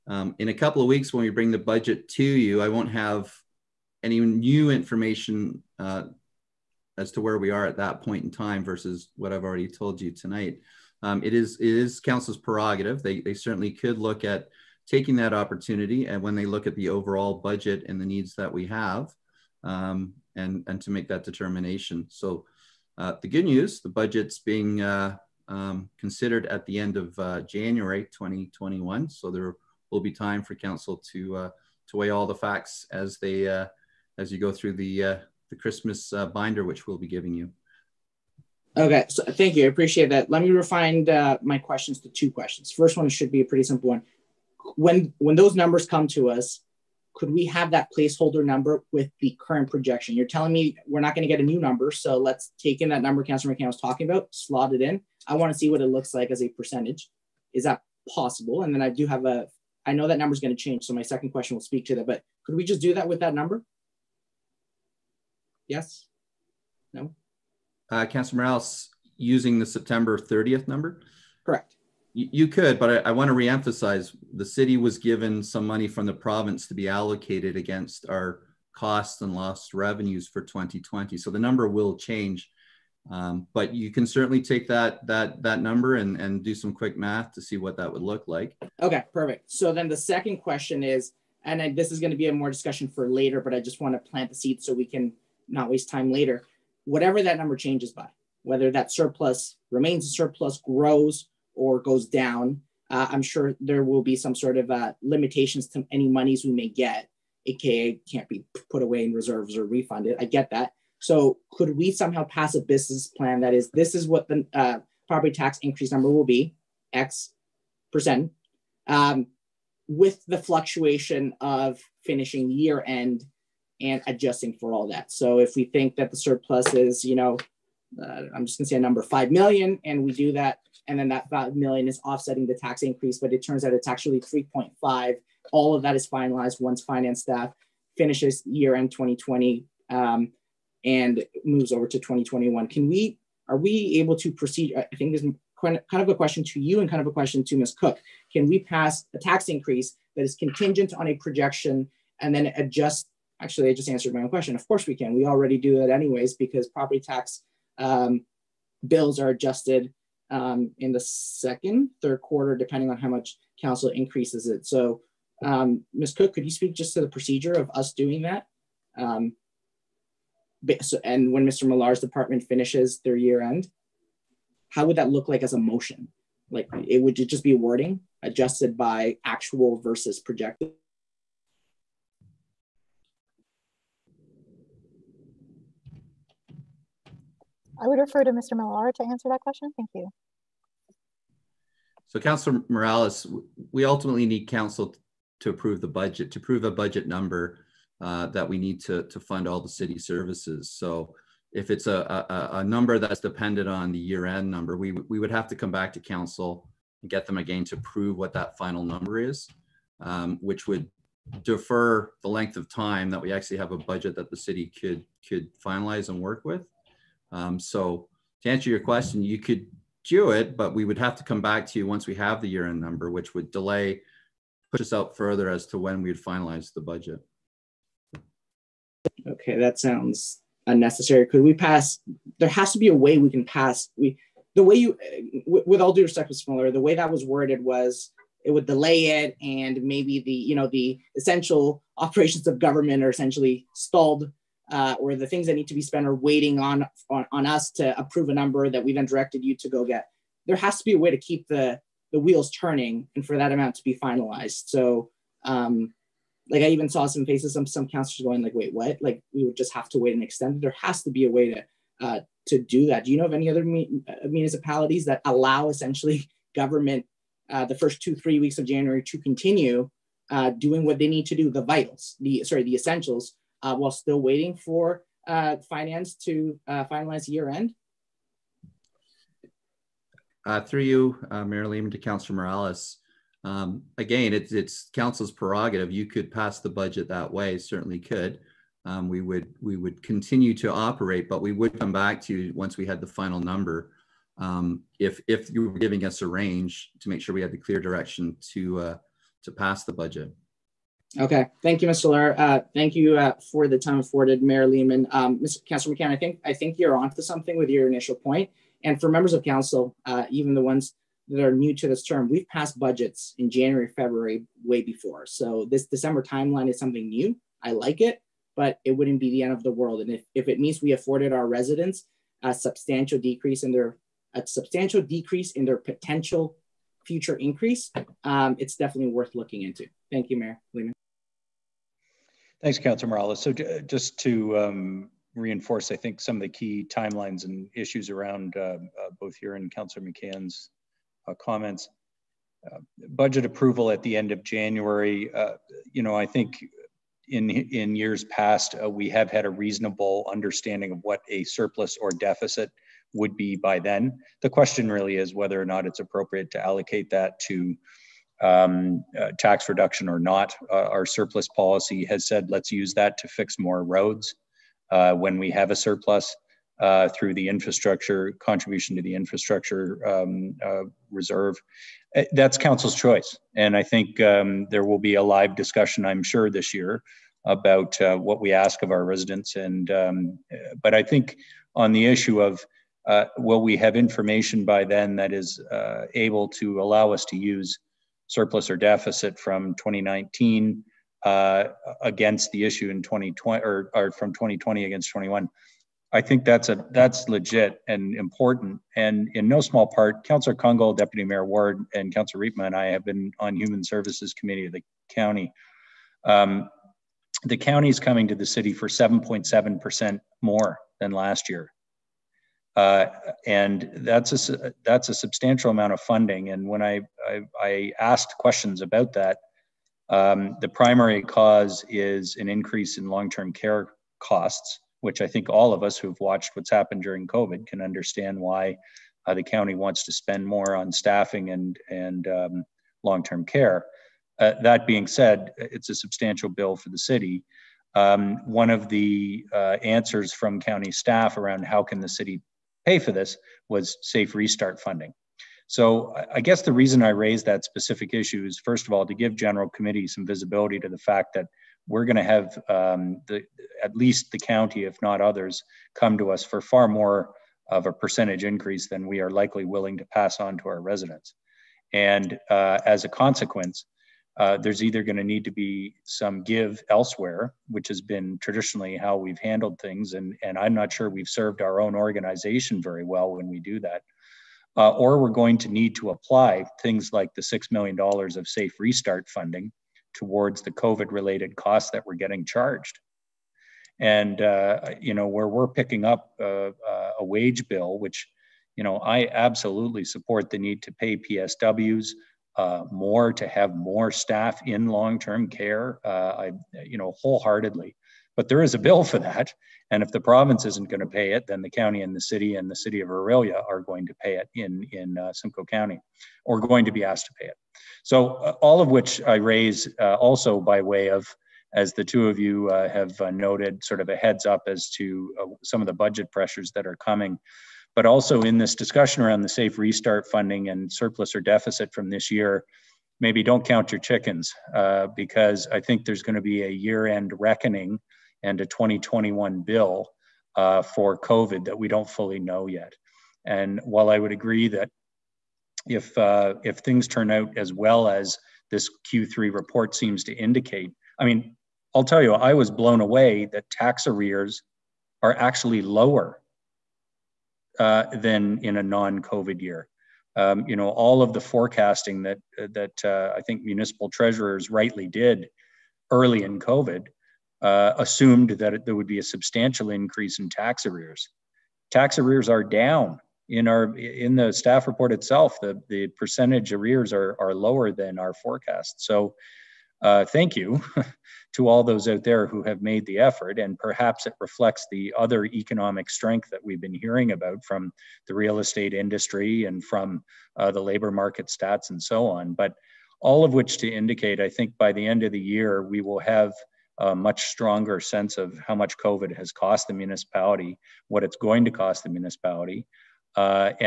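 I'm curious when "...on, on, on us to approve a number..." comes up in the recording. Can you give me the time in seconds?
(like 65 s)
246 s.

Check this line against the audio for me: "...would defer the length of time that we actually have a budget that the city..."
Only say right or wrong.
right.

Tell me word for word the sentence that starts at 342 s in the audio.
Uh, budget approval at the end of January.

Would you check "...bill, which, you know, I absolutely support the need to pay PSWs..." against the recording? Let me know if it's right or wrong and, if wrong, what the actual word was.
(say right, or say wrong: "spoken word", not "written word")
right.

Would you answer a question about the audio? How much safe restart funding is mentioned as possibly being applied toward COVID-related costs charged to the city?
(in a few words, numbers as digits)
$6 million.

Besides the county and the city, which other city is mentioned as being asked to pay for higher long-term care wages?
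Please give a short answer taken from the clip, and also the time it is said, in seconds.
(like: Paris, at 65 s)
Orillia, at 503 s.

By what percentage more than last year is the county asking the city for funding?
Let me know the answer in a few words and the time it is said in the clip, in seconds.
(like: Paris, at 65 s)
7.7%, at 408 s.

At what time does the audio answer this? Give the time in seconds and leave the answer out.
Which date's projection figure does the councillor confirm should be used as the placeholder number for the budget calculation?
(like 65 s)
69 s.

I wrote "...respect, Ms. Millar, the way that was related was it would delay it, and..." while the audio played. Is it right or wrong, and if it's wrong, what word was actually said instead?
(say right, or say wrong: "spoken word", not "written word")
wrong: "worded", not "related".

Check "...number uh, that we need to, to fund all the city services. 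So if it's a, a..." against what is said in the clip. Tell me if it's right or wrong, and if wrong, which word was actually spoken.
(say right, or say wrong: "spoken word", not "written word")
right.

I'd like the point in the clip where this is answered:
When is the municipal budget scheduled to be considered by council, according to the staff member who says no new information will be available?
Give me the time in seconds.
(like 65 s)
26 s.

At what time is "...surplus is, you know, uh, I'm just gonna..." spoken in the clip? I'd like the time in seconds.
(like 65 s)
126 s.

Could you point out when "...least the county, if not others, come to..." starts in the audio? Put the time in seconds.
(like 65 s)
453 s.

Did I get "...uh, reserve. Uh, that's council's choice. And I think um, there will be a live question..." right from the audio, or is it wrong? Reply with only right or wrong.
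wrong.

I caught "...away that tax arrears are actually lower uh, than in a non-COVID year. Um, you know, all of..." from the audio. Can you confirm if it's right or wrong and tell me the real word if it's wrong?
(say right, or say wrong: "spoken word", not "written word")
right.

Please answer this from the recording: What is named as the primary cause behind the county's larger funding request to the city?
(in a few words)
long-term care costs.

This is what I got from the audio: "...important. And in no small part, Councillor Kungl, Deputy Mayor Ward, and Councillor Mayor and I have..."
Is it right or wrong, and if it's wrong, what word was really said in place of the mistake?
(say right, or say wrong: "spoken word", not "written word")
wrong: "Riepma", not "Mayor".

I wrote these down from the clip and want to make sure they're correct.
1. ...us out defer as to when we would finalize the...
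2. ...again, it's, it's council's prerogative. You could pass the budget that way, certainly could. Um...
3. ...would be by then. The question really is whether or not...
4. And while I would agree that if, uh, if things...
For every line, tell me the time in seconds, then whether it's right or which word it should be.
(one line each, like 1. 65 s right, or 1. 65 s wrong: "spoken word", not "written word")
1. 224 s wrong: "further", not "defer"
2. 283 s right
3. 353 s right
4. 533 s right.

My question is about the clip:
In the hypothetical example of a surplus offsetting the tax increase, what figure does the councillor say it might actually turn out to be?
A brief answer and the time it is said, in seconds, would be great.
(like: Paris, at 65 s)
3.5 million, at 134 s.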